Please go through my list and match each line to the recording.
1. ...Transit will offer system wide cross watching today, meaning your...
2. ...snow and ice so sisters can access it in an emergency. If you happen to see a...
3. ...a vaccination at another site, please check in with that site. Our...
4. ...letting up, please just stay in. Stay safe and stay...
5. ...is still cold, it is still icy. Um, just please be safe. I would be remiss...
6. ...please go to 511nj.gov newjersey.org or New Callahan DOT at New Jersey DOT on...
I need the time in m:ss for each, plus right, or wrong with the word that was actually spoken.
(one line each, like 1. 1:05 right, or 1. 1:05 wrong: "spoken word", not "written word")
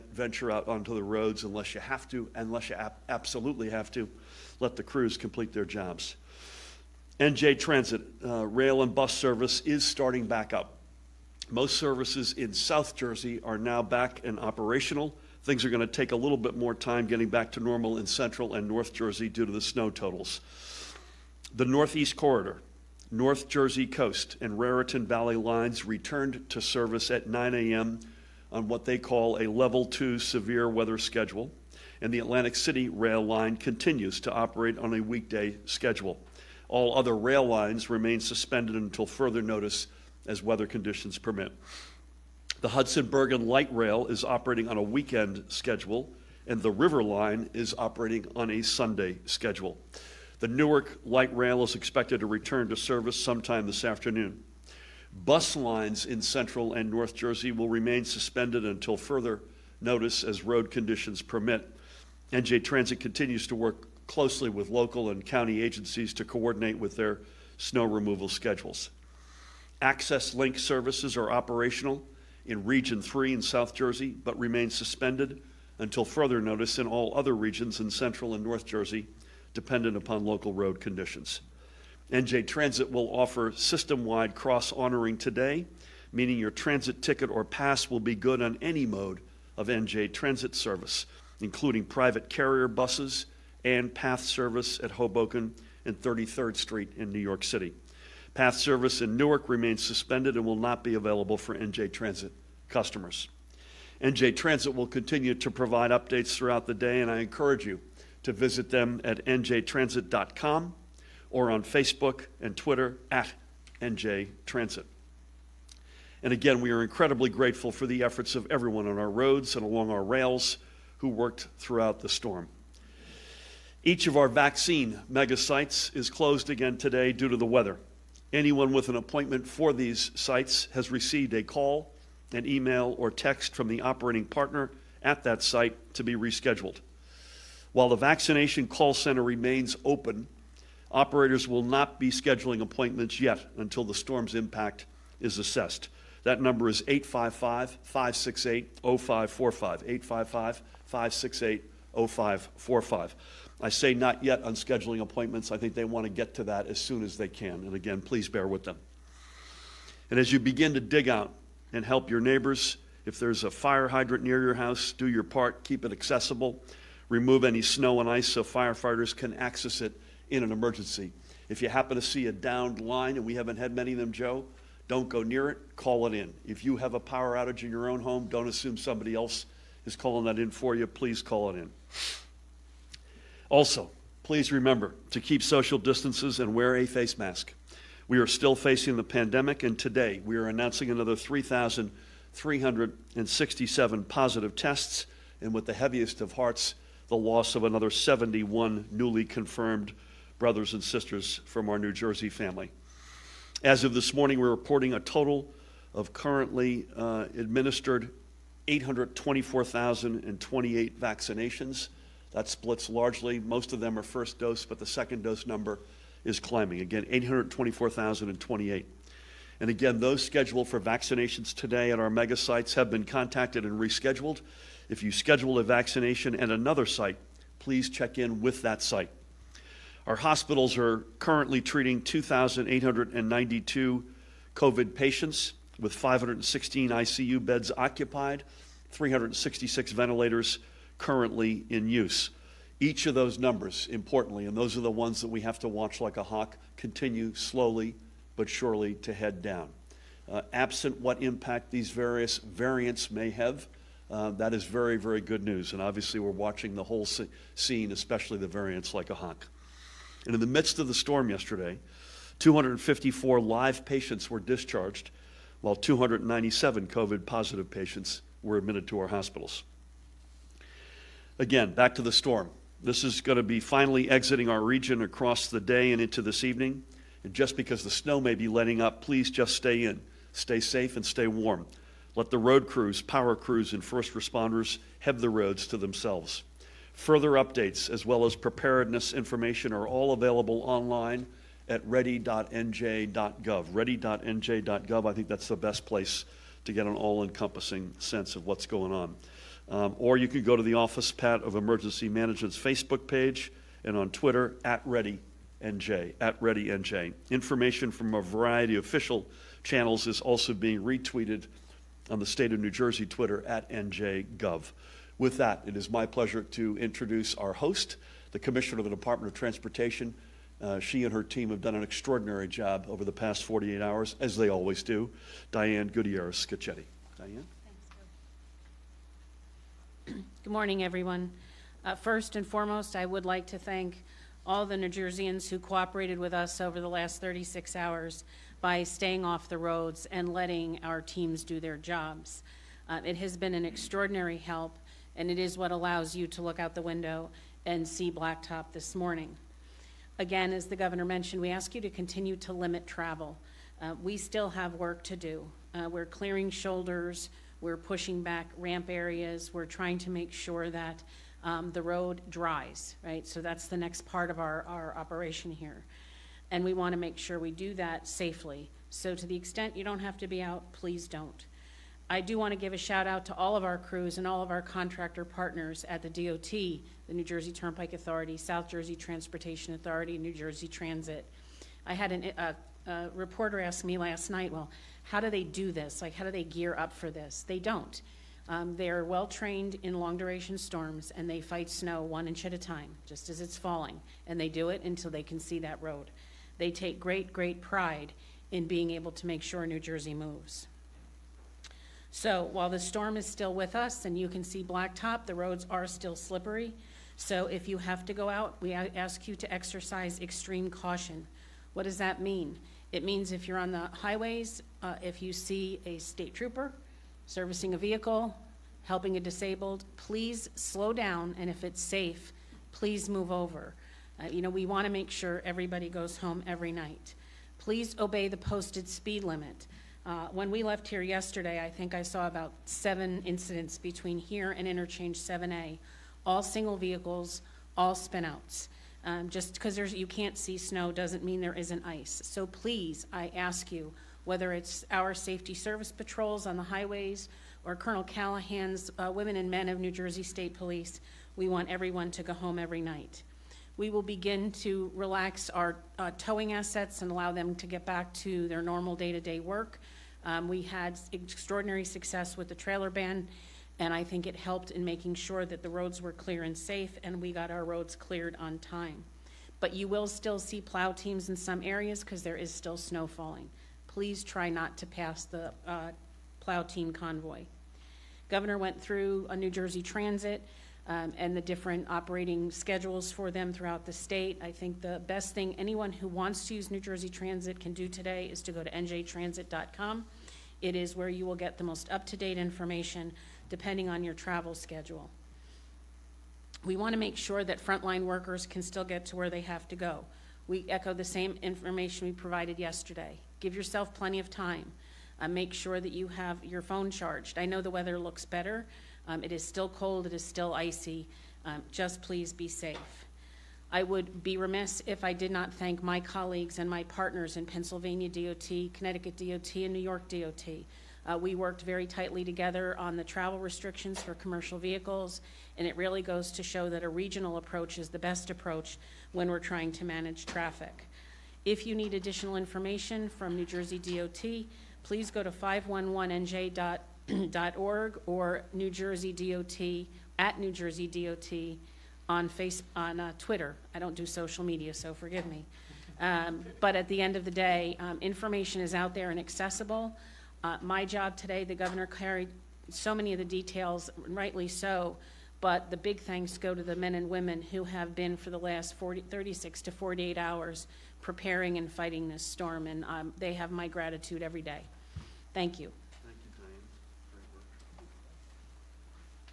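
1. 1:22 wrong: "honoring", not "watching"
2. 2:47 wrong: "firefighters", not "sisters"
3. 3:45 right
4. 4:38 right
5. 8:29 right
6. 8:54 wrong: "Jersey", not "Callahan".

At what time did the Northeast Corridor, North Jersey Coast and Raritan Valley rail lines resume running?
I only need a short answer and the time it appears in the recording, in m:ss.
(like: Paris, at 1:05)
9 a.m., at 0:27.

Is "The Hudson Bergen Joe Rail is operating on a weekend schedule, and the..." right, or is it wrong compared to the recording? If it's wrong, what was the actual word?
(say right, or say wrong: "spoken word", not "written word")
wrong: "Light", not "Joe".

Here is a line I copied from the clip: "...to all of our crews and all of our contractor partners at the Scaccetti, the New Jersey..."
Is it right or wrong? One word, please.
wrong.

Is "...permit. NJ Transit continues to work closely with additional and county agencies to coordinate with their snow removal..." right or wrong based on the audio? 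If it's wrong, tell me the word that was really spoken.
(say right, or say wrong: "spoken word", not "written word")
wrong: "local", not "additional".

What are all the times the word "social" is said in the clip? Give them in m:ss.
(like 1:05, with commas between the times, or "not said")
3:05, 9:04.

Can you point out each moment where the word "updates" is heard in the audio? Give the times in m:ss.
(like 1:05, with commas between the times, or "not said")
1:45, 4:47.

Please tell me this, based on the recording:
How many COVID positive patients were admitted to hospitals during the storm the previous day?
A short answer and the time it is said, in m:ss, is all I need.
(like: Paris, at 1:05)
297, at 4:25.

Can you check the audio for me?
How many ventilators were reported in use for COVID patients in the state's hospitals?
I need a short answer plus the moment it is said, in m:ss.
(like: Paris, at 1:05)
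366, at 3:58.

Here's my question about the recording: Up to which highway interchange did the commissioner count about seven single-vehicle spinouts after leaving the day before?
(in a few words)
7A.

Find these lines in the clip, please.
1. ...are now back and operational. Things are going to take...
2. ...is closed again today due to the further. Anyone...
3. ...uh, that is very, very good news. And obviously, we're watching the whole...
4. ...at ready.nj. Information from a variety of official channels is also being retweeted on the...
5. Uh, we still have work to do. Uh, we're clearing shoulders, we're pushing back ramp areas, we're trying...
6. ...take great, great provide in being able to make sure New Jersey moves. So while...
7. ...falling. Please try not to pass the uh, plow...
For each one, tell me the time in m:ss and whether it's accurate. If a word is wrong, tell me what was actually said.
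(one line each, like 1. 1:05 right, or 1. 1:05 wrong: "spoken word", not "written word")
1. 0:13 right
2. 2:05 wrong: "weather", not "further"
3. 4:14 right
4. 5:06 right
5. 5:53 right
6. 6:36 wrong: "pride", not "provide"
7. 7:53 right.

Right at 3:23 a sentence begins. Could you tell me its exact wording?
As of this morning, we're reporting a total of currently uh, administered 824,028 vaccinations.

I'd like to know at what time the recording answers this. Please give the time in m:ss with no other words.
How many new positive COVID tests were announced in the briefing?
3:11.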